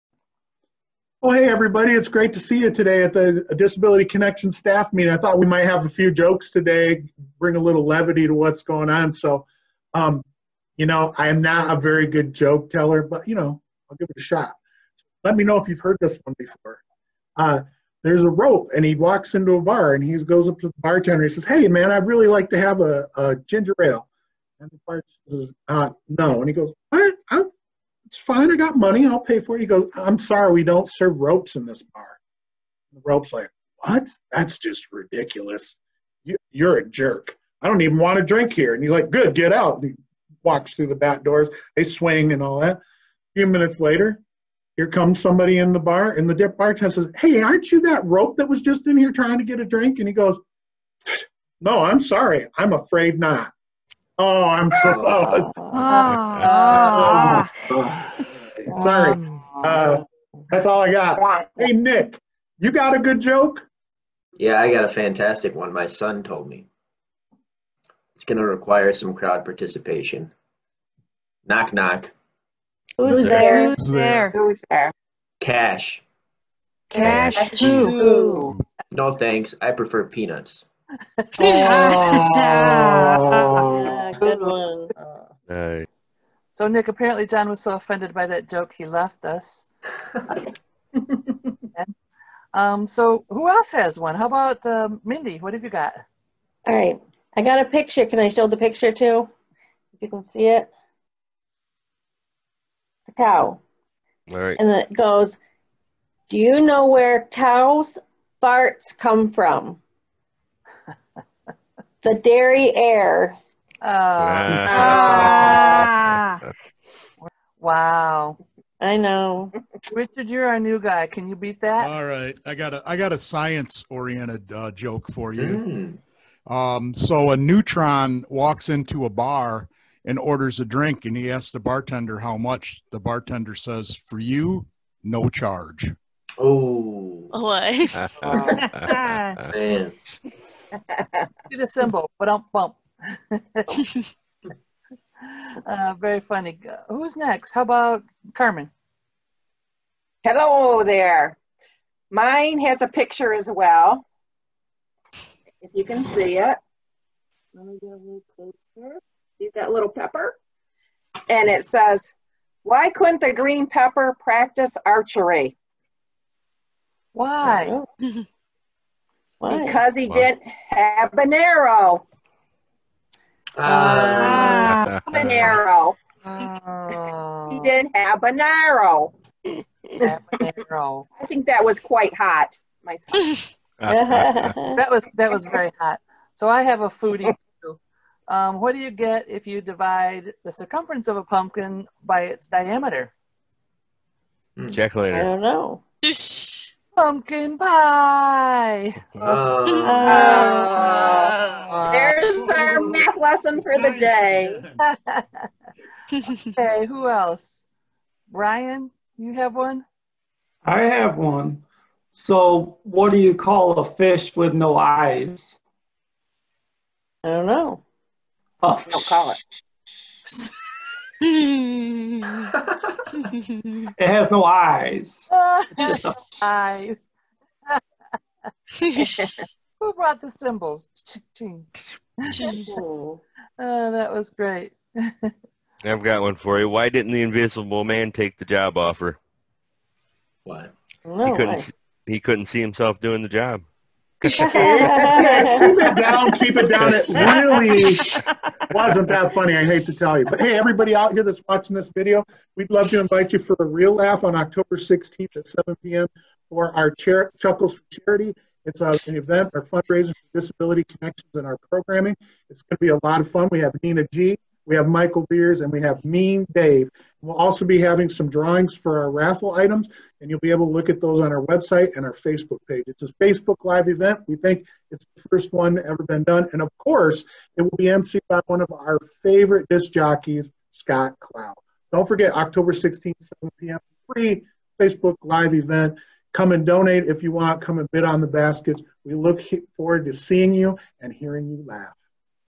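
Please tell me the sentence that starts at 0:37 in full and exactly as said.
I don't even want to drink here.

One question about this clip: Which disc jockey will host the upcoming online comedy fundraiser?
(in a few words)
Scott Clow.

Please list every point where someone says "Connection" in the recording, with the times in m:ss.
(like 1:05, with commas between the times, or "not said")
0:04, 4:20.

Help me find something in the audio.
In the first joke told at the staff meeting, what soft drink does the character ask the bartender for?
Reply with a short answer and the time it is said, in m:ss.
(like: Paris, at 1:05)
Ginger ale, at 0:23.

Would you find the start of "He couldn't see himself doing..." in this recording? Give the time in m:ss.
4:02.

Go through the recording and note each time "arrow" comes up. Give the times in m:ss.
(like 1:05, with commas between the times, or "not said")
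2:51, 2:58.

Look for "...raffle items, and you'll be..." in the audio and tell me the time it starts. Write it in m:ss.
4:29.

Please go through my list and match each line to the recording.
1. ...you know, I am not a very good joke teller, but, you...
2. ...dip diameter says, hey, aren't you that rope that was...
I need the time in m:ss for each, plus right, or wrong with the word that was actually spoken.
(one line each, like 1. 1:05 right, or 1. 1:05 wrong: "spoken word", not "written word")
1. 0:10 right
2. 0:46 wrong: "bartender", not "diameter".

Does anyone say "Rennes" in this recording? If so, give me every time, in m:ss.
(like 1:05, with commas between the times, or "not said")
not said.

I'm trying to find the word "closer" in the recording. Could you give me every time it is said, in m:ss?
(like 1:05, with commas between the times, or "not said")
2:38.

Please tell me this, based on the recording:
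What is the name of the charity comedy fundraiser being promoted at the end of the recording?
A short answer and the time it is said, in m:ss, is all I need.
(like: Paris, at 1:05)
Chuckles for Charity, at 4:17.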